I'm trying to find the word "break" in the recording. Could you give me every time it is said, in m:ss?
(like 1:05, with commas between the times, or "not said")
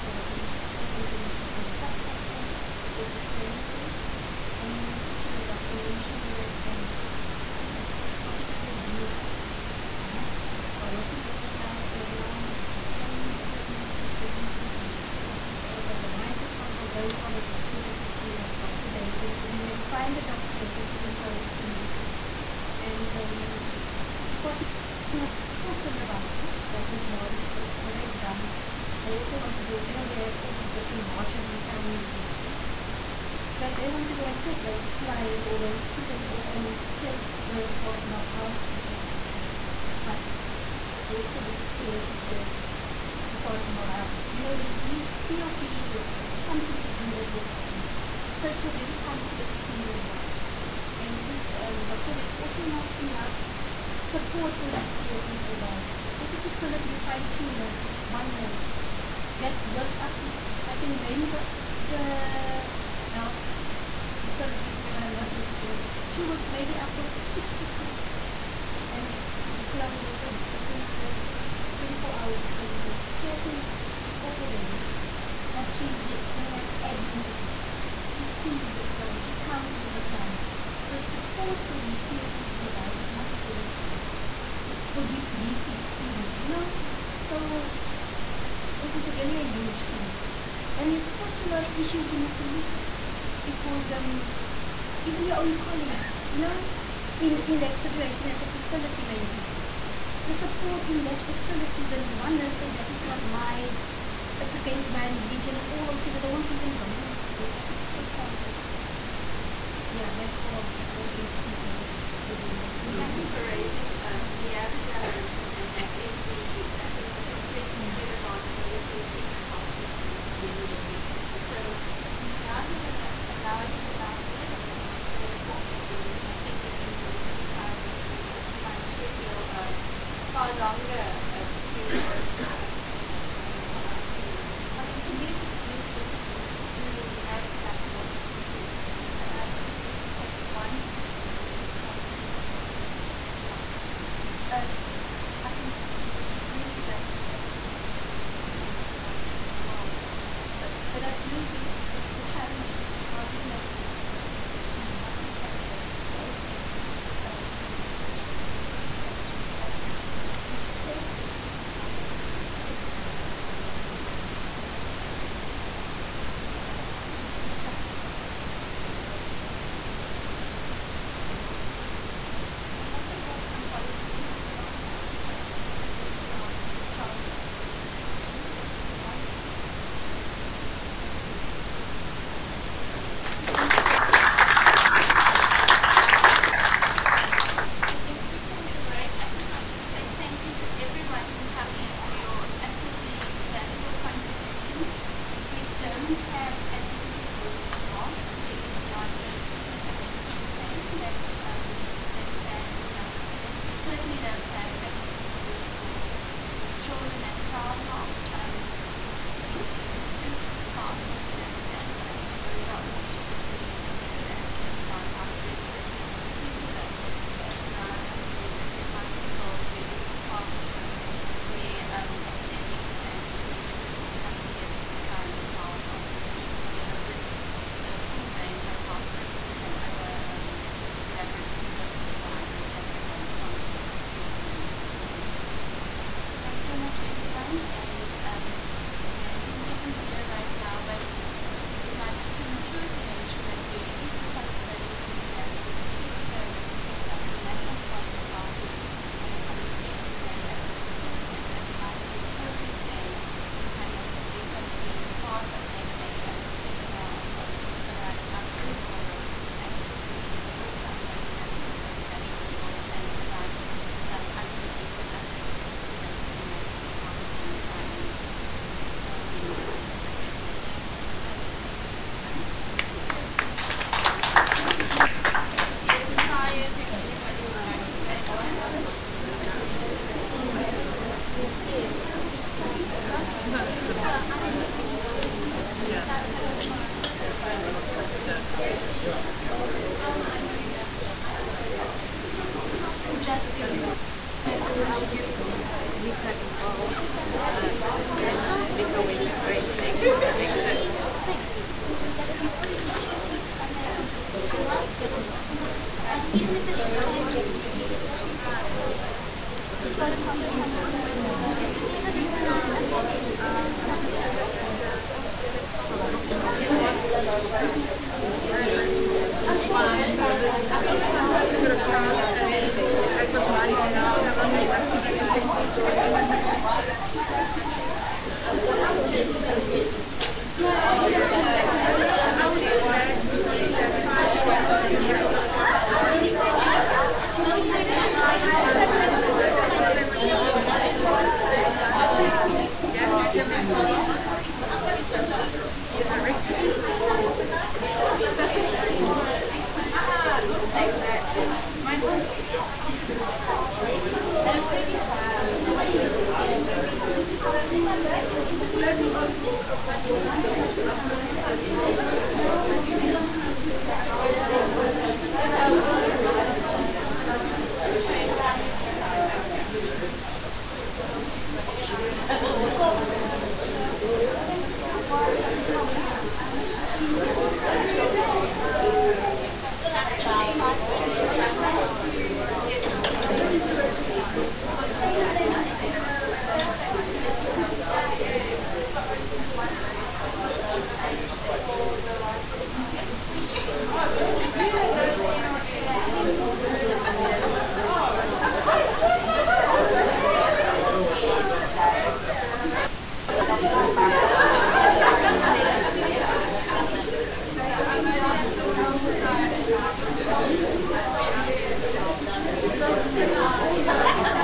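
3:08.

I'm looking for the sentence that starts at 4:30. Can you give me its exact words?
So thank you so much, everyone.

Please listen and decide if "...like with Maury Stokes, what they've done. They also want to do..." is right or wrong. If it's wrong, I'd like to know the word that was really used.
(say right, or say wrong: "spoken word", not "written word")
right.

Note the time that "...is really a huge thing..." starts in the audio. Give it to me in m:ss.
1:28.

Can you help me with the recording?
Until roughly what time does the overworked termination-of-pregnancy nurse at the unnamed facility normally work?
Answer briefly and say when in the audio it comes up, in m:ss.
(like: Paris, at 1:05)
6 o'clock, at 1:07.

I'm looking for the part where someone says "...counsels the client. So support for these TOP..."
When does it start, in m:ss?
1:19.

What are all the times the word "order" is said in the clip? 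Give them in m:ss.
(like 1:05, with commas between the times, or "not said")
2:44.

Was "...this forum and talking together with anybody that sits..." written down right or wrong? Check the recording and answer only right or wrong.
wrong.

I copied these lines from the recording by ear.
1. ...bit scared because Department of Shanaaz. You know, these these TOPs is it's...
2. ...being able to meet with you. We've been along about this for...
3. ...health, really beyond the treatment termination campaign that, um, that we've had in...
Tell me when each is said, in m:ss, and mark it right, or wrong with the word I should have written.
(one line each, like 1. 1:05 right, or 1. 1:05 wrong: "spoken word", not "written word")
1. 0:41 wrong: "Health", not "Shanaaz"
2. 2:27 wrong: "talking", not "along"
3. 3:17 wrong: "action", not "termination".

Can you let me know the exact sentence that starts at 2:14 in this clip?
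I mean, for me, it was really difficult to know exactly what to include, and, I agree mm-hmm.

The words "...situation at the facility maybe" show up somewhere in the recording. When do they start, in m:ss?
1:37.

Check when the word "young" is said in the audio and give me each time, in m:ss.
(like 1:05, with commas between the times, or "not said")
2:42.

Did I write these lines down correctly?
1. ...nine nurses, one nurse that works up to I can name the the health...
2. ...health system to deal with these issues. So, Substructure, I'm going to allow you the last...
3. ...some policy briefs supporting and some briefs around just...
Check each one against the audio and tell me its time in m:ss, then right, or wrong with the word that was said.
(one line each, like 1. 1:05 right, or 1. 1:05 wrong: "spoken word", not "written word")
1. 0:57 wrong: "two", not "nine"
2. 1:59 wrong: "Shanaaz", not "Substructure"
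3. 2:53 wrong: "along", not "supporting".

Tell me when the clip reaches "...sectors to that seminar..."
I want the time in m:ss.
4:25.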